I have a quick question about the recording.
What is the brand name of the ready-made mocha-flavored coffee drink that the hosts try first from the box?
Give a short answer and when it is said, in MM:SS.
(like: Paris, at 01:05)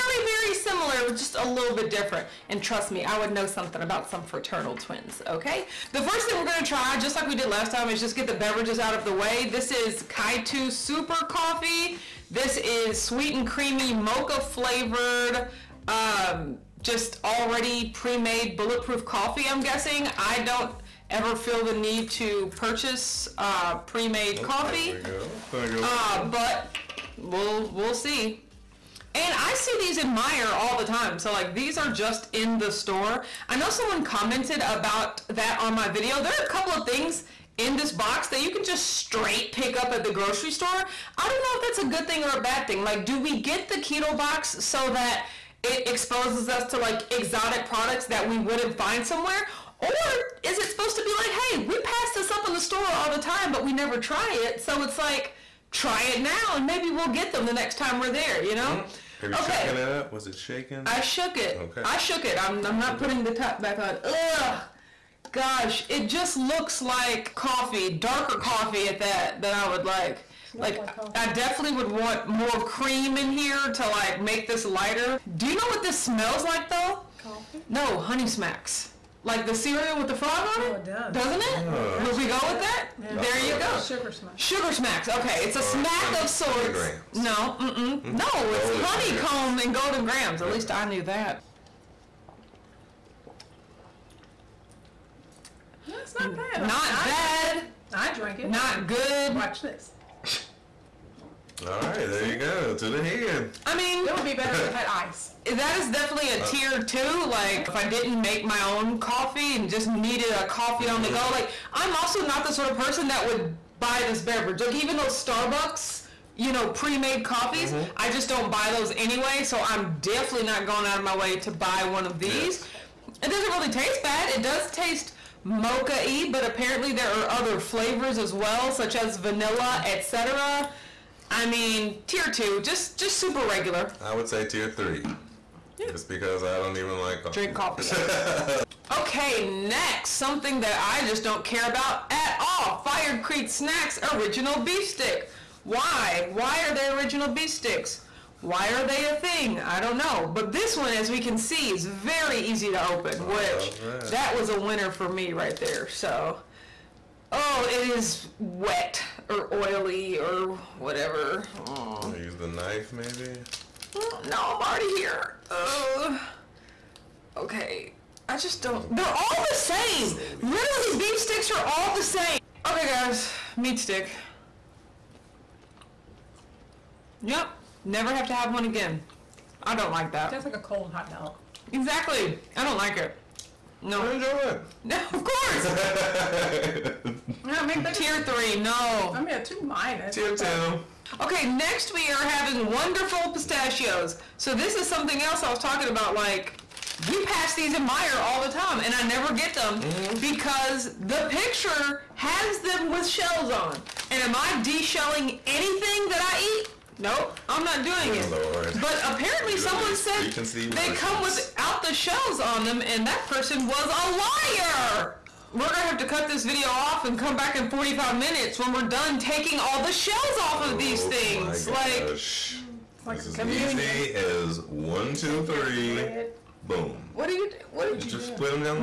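Kitu Super Coffee, at 00:10.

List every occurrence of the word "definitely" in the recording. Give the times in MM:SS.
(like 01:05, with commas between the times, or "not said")
01:11, 01:45, 02:00.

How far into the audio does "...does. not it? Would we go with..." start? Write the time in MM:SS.
01:21.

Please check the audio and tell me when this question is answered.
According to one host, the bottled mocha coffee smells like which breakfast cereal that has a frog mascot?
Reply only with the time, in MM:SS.
01:17.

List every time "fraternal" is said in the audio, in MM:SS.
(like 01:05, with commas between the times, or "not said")
00:04.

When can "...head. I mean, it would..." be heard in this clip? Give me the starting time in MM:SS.
01:43.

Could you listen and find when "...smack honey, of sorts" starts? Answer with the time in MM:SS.
01:25.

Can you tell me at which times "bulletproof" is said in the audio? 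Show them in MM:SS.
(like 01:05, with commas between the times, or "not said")
00:18.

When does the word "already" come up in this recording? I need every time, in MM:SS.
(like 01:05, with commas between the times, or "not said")
00:17, 02:44.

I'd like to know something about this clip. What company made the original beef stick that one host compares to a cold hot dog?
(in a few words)
Fired Creek Snacks.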